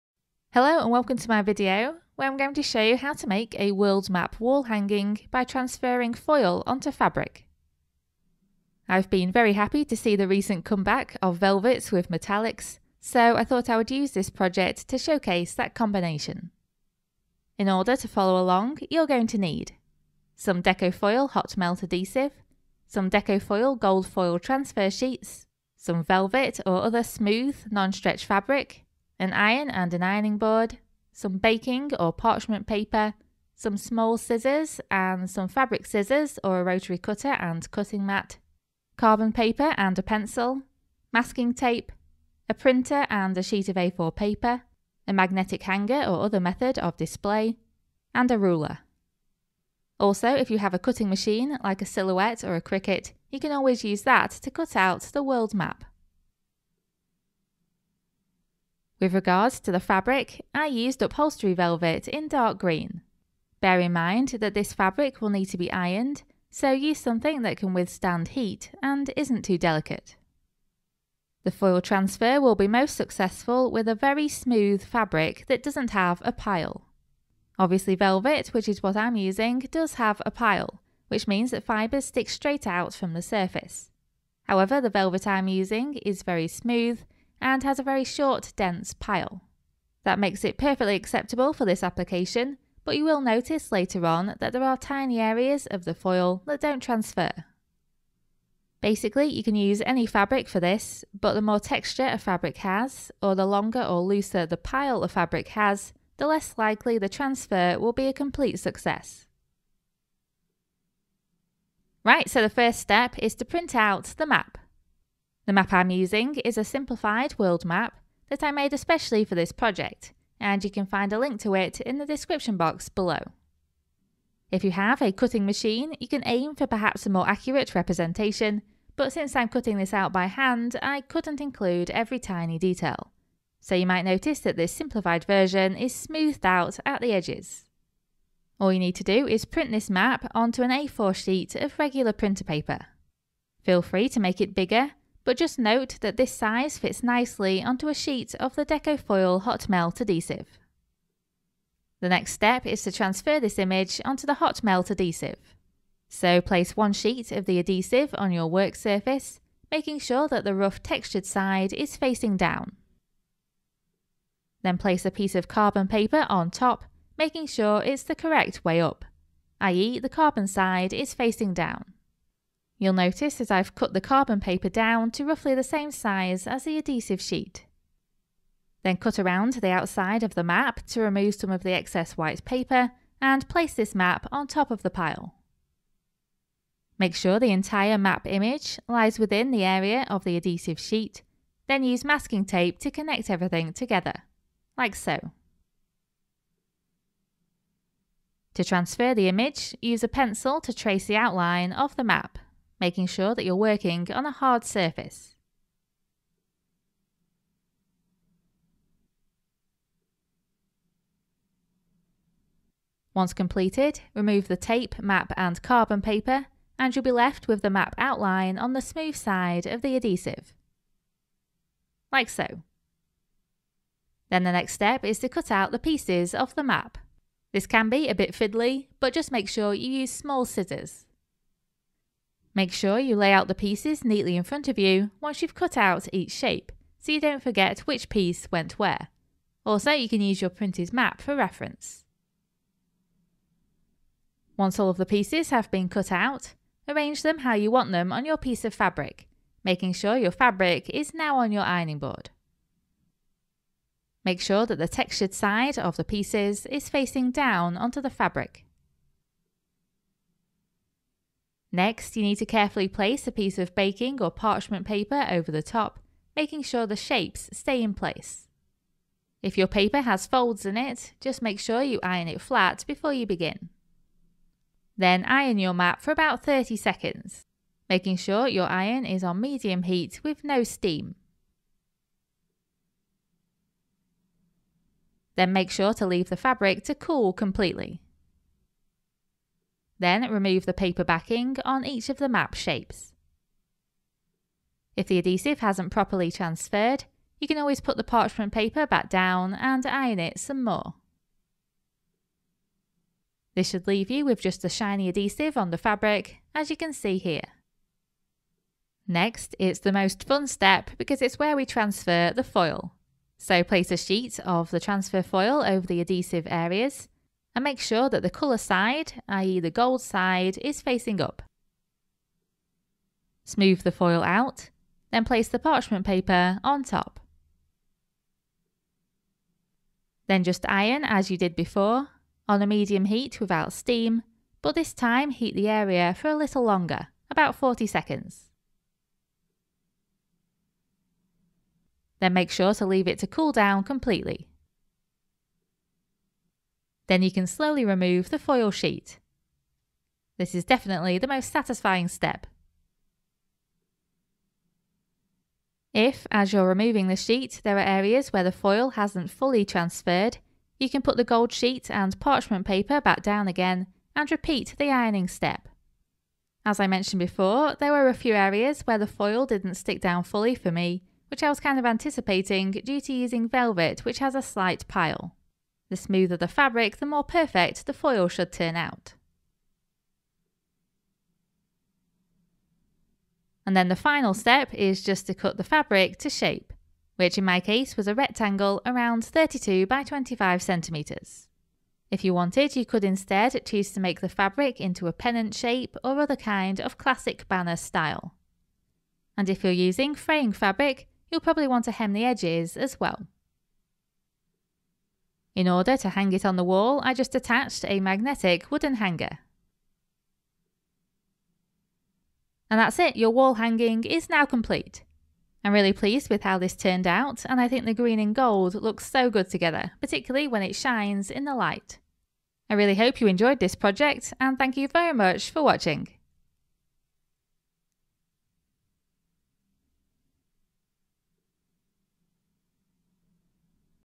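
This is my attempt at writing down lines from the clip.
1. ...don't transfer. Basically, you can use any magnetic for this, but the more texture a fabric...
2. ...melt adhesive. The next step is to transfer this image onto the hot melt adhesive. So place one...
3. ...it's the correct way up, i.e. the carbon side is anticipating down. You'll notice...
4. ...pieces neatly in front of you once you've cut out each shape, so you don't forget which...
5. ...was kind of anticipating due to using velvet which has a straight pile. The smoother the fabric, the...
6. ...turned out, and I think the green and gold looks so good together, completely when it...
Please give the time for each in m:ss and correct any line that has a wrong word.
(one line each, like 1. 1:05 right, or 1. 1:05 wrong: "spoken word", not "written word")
1. 1:36 wrong: "fabric", not "magnetic"
2. 2:29 right
3. 2:47 wrong: "facing", not "anticipating"
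4. 3:53 right
5. 6:11 wrong: "slight", not "straight"
6. 6:56 wrong: "particularly", not "completely".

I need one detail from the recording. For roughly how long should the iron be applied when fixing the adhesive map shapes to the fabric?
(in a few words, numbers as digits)
30 seconds.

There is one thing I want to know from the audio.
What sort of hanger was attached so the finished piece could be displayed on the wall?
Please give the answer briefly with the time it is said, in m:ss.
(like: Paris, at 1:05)
Magnetic wooden hanger, at 6:47.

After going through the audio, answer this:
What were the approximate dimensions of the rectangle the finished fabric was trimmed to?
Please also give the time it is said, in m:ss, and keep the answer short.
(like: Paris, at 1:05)
32 by 25 centimetres, at 6:29.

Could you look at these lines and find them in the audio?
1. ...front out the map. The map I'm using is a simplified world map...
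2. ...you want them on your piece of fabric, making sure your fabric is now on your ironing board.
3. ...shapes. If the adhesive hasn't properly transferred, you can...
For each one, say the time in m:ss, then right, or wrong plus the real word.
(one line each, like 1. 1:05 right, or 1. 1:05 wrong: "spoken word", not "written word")
1. 1:53 wrong: "print", not "front"
2. 4:07 right
3. 4:52 right.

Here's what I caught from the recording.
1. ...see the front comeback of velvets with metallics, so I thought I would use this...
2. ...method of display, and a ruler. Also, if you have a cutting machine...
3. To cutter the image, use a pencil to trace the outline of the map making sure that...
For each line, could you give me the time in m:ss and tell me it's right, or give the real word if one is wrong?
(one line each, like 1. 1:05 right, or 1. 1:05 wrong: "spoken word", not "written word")
1. 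0:09 wrong: "recent", not "front"
2. 0:46 right
3. 3:18 wrong: "transfer", not "cutter".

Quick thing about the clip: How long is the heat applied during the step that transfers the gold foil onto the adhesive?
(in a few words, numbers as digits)
40 seconds.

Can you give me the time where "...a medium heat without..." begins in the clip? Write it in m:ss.
5:32.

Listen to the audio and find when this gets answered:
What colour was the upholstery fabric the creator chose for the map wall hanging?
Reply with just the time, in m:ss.
1:02.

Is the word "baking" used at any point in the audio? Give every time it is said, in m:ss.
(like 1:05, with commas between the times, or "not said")
0:31, 4:23.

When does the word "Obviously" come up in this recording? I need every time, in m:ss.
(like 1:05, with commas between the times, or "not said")
1:17.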